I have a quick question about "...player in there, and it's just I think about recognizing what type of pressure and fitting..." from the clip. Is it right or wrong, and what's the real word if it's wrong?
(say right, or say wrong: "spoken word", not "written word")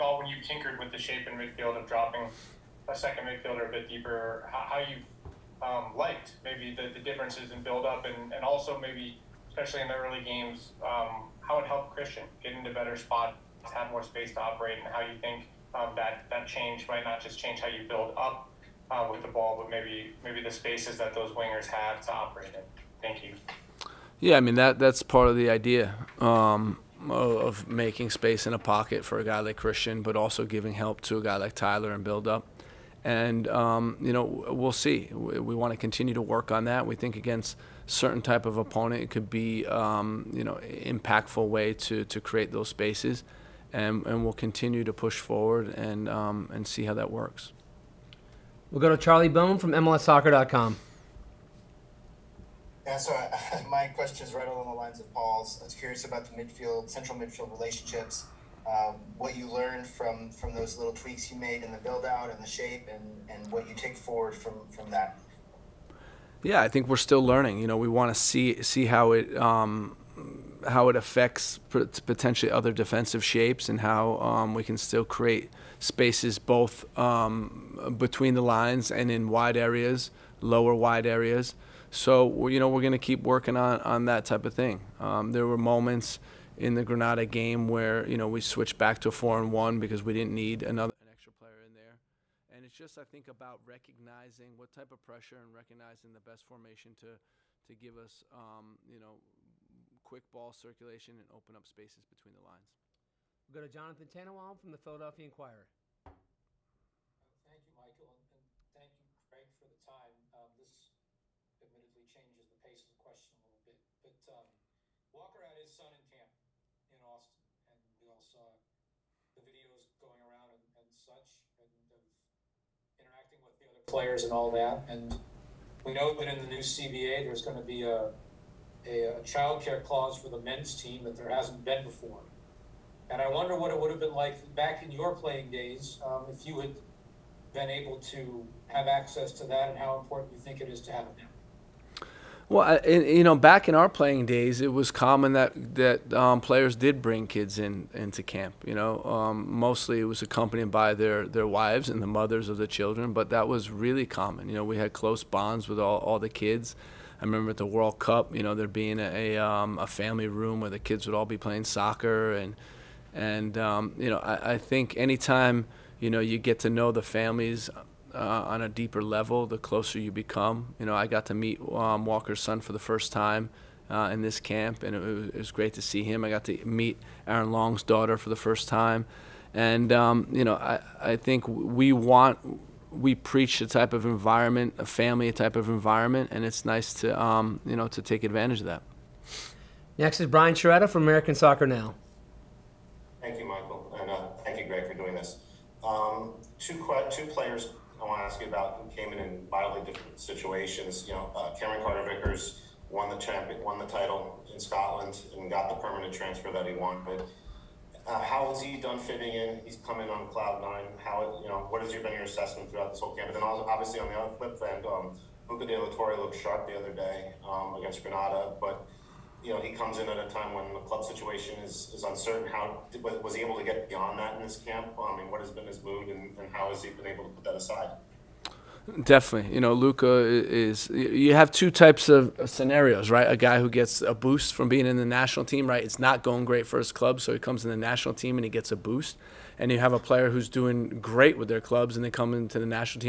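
wrong: "recognizing", not "fitting".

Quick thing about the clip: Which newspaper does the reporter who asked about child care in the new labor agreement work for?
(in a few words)
Philadelphia Inquirer.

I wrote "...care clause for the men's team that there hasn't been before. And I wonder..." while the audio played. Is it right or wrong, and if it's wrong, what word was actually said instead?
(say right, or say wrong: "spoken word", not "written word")
right.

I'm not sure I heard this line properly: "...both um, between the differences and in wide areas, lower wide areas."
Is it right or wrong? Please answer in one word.
wrong.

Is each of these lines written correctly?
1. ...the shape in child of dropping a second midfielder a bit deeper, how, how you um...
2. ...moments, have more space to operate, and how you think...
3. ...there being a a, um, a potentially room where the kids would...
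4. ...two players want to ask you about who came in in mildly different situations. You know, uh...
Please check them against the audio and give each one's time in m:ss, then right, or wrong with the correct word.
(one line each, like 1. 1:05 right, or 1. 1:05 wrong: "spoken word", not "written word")
1. 0:00 wrong: "midfield", not "child"
2. 0:12 wrong: "spots", not "moments"
3. 2:38 wrong: "family", not "potentially"
4. 3:17 right.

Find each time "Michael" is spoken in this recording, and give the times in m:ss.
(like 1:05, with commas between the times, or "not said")
1:47, 3:13.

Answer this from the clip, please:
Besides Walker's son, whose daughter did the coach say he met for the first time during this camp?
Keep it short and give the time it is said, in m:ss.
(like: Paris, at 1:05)
Aaron Long, at 2:57.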